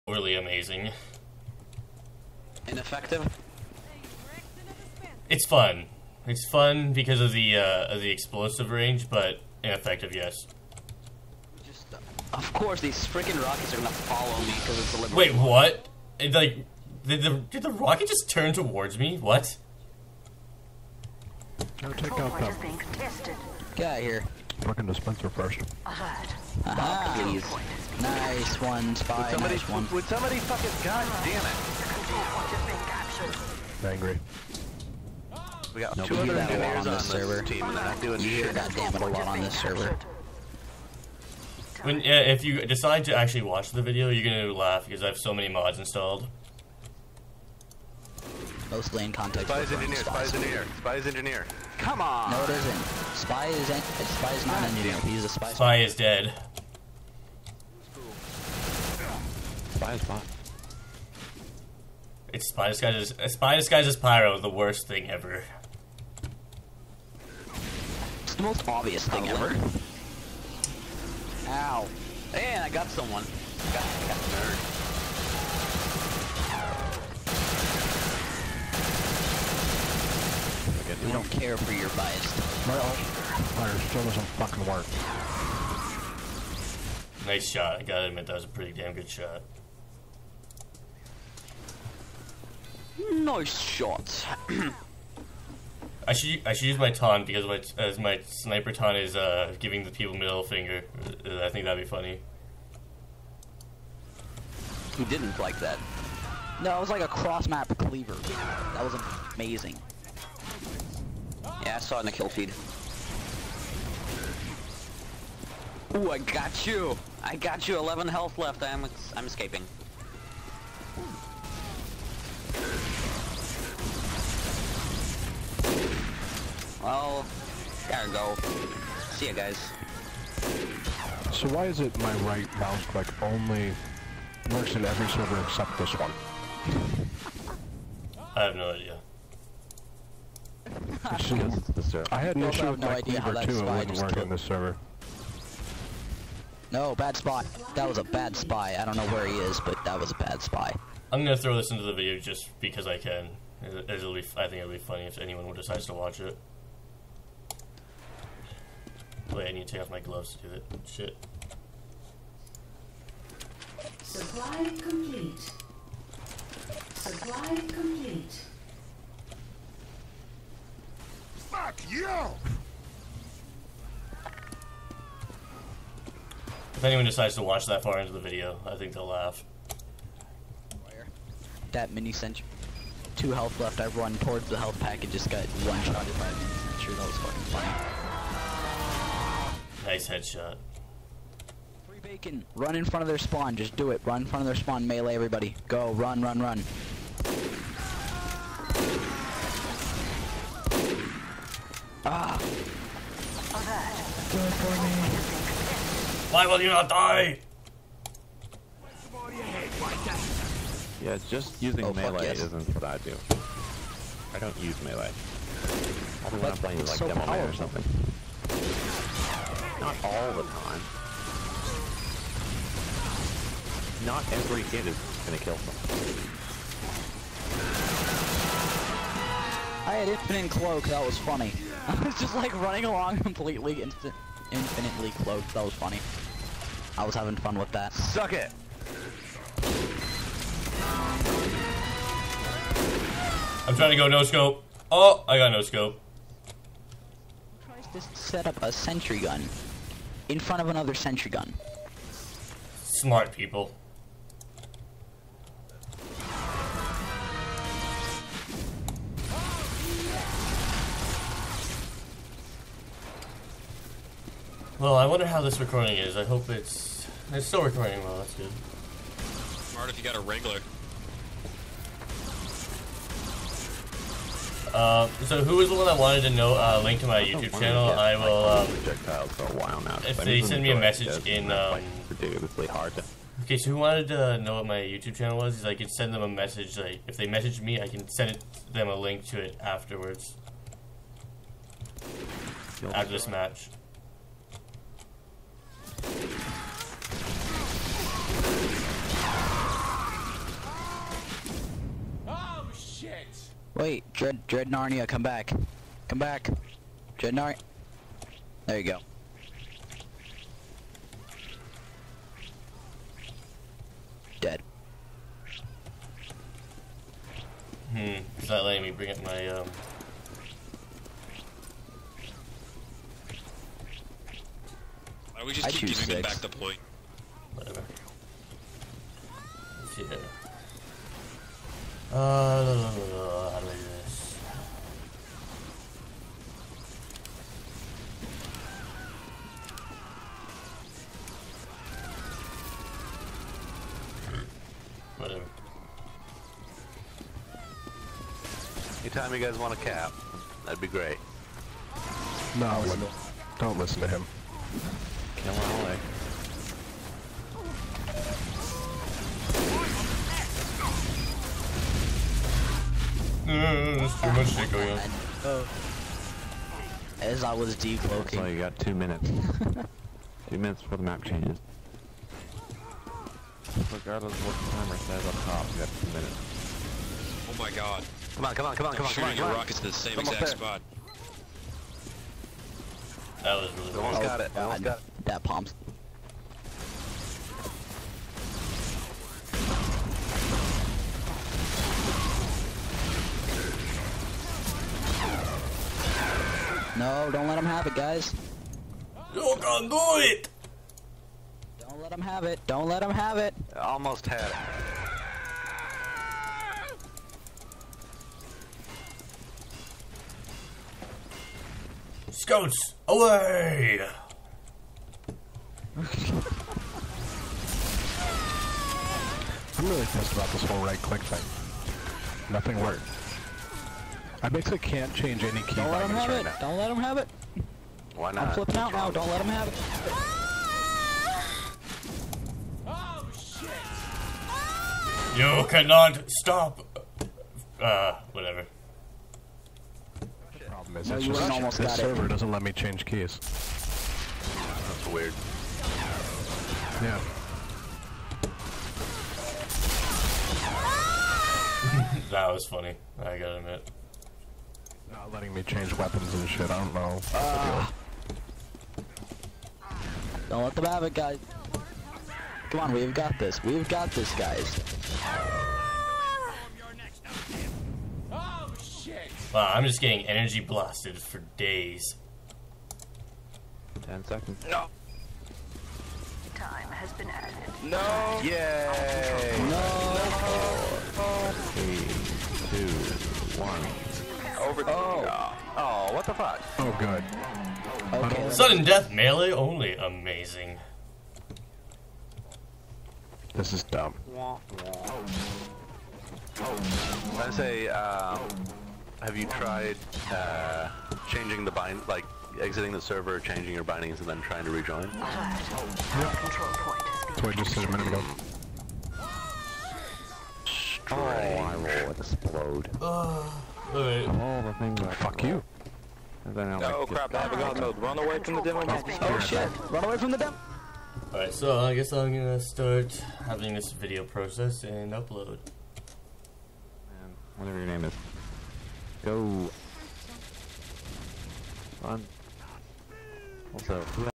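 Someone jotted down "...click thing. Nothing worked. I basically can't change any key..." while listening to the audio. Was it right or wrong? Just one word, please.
right.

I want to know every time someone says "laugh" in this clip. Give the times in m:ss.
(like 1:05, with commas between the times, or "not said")
0:44, 2:59.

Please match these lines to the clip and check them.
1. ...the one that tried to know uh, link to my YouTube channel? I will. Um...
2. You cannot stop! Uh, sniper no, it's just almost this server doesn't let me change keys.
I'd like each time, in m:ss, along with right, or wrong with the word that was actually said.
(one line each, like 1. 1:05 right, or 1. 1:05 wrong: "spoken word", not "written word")
1. 4:35 wrong: "wanted", not "tried"
2. 7:15 wrong: "whatever", not "sniper".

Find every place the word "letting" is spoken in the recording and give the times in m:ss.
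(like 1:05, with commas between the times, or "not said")
5:18, 7:35.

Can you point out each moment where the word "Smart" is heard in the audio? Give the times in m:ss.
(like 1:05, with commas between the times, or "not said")
4:12, 4:29.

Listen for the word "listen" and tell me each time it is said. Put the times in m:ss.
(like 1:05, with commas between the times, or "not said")
5:53.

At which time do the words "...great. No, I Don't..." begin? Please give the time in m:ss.
5:50.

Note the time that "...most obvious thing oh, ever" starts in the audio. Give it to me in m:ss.
1:08.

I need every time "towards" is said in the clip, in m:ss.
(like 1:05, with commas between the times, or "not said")
0:18, 3:04.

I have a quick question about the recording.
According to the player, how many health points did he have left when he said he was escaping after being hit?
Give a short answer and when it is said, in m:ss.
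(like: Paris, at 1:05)
11, at 1:57.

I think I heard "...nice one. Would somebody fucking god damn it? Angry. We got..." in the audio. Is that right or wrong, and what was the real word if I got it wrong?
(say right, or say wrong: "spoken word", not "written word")
right.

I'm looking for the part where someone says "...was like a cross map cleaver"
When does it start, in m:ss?
1:46.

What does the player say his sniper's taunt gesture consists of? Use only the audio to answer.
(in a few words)
Middle finger.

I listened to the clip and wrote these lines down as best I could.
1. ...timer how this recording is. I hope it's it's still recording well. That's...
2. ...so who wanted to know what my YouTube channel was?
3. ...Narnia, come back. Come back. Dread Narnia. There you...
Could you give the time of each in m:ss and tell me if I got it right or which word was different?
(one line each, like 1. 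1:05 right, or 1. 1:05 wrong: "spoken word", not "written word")
1. 4:25 wrong: "wonder", not "timer"
2. 4:43 right
3. 5:04 right.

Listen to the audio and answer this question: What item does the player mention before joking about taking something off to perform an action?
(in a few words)
Gloves.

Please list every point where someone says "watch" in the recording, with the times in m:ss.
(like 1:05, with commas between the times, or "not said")
0:43, 2:35, 2:57.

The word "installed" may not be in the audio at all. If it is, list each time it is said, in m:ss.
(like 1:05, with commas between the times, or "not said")
0:45.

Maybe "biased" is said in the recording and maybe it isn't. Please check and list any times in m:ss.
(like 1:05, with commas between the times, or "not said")
1:21.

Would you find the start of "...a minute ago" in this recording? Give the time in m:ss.
8:27.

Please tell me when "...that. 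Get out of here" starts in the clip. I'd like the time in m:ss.
0:22.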